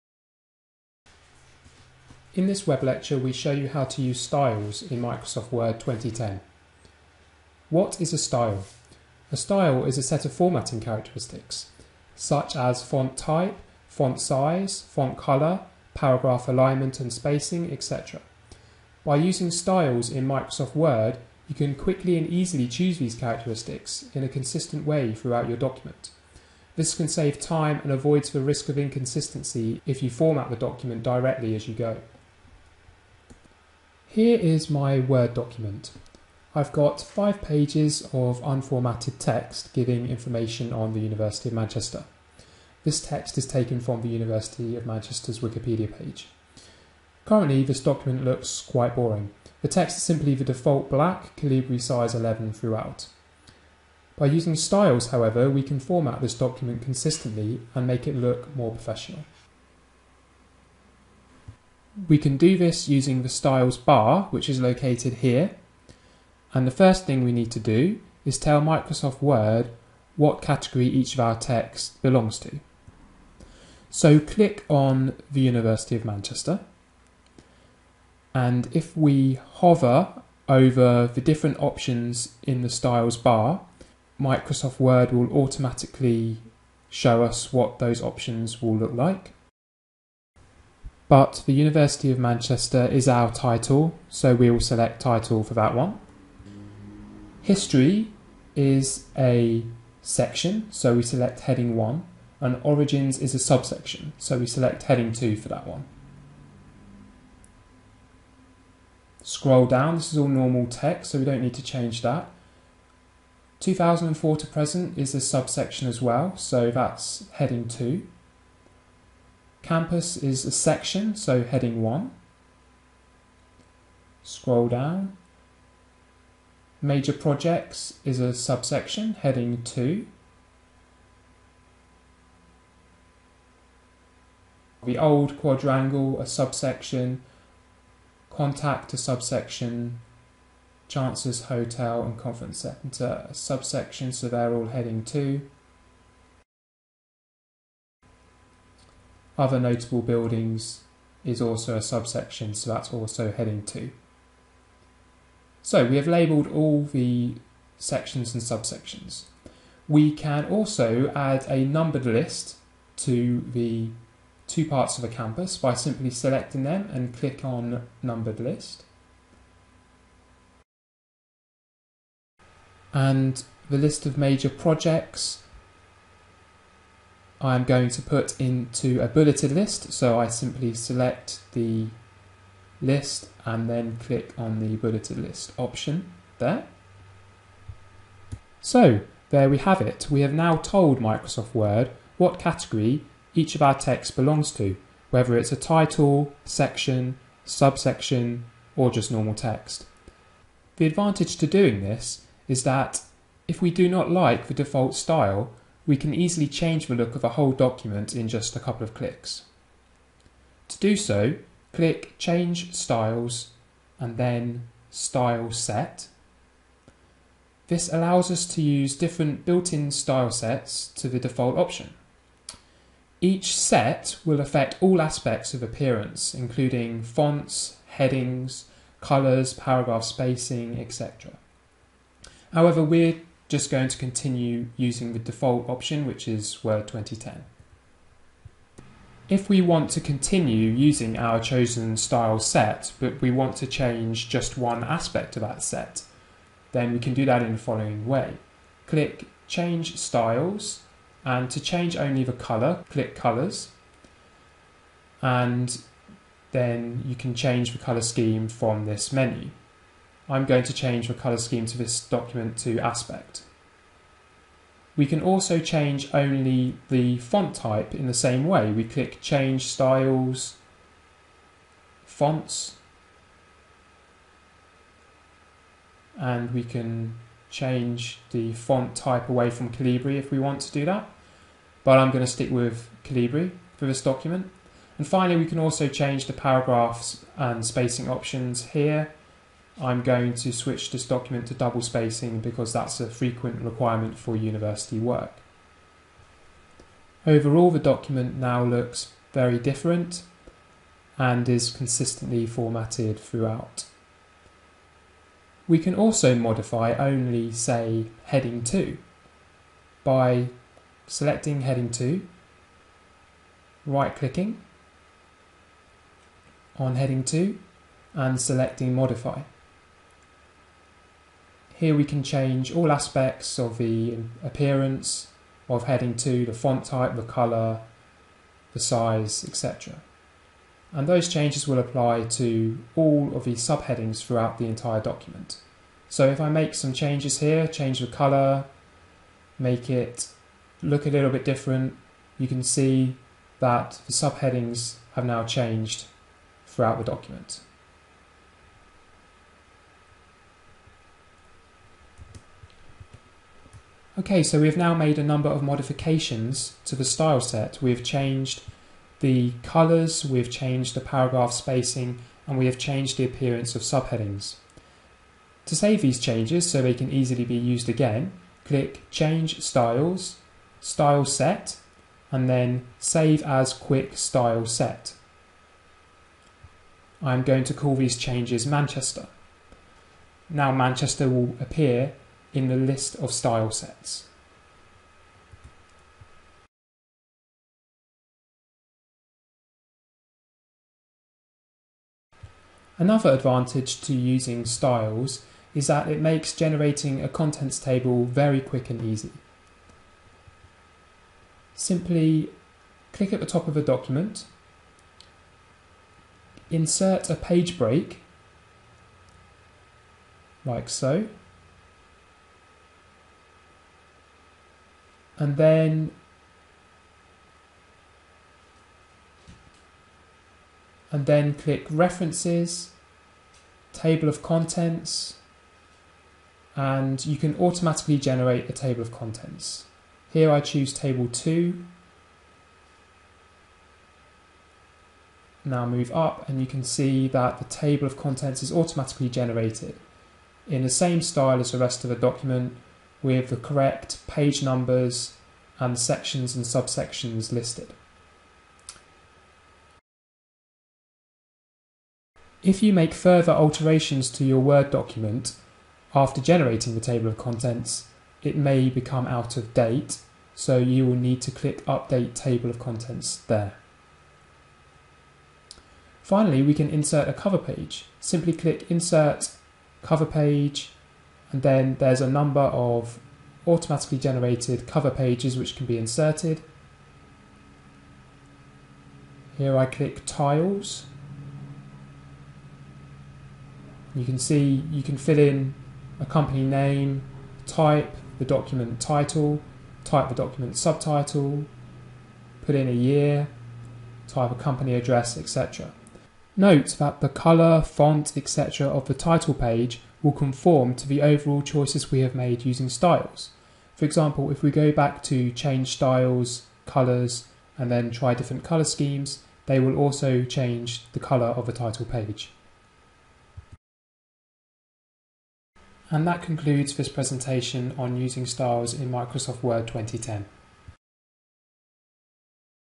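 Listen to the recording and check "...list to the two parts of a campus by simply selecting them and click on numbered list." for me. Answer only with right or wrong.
right.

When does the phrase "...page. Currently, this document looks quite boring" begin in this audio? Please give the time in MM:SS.
00:45.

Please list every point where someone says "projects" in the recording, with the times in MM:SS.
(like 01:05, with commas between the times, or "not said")
02:07, 02:54.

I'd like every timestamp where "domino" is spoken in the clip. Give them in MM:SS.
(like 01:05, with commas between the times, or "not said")
not said.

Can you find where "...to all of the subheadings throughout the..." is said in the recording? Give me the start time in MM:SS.
05:32.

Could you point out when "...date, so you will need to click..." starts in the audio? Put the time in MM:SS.
07:39.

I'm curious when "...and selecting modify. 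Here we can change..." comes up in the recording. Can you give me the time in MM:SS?
05:18.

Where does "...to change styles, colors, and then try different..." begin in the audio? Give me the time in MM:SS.
08:25.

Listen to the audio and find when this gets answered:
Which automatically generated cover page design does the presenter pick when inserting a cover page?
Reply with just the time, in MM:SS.
08:00.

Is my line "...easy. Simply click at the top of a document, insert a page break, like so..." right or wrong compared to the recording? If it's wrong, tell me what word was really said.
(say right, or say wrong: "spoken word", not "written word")
right.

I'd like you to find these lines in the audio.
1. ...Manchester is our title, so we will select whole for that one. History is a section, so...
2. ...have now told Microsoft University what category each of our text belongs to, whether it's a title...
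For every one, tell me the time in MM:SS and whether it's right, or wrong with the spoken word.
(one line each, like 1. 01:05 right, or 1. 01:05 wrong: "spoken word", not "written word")
1. 01:32 wrong: "title", not "whole"
2. 03:10 wrong: "Word", not "University".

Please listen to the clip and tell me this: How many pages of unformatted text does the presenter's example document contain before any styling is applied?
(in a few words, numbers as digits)
5.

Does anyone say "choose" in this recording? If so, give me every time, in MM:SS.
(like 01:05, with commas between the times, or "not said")
00:22, 07:10.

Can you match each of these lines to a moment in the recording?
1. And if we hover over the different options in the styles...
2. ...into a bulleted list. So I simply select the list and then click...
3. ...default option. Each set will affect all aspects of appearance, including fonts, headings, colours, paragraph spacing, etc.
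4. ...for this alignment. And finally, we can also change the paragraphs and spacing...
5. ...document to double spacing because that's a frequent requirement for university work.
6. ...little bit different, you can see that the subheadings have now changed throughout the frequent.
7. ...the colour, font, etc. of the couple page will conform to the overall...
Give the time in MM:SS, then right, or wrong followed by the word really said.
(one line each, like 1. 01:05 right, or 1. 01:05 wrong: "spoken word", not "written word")
1. 01:18 right
2. 02:58 right
3. 03:41 right
4. 04:43 wrong: "document", not "alignment"
5. 04:51 right
6. 05:41 wrong: "document", not "frequent"
7. 08:17 wrong: "title", not "couple".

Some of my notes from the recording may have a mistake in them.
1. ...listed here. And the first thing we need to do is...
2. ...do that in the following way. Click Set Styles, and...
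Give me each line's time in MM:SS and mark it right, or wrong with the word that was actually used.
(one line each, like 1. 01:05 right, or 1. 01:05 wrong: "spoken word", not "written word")
1. 01:04 wrong: "located", not "listed"
2. 04:07 wrong: "Change", not "Set".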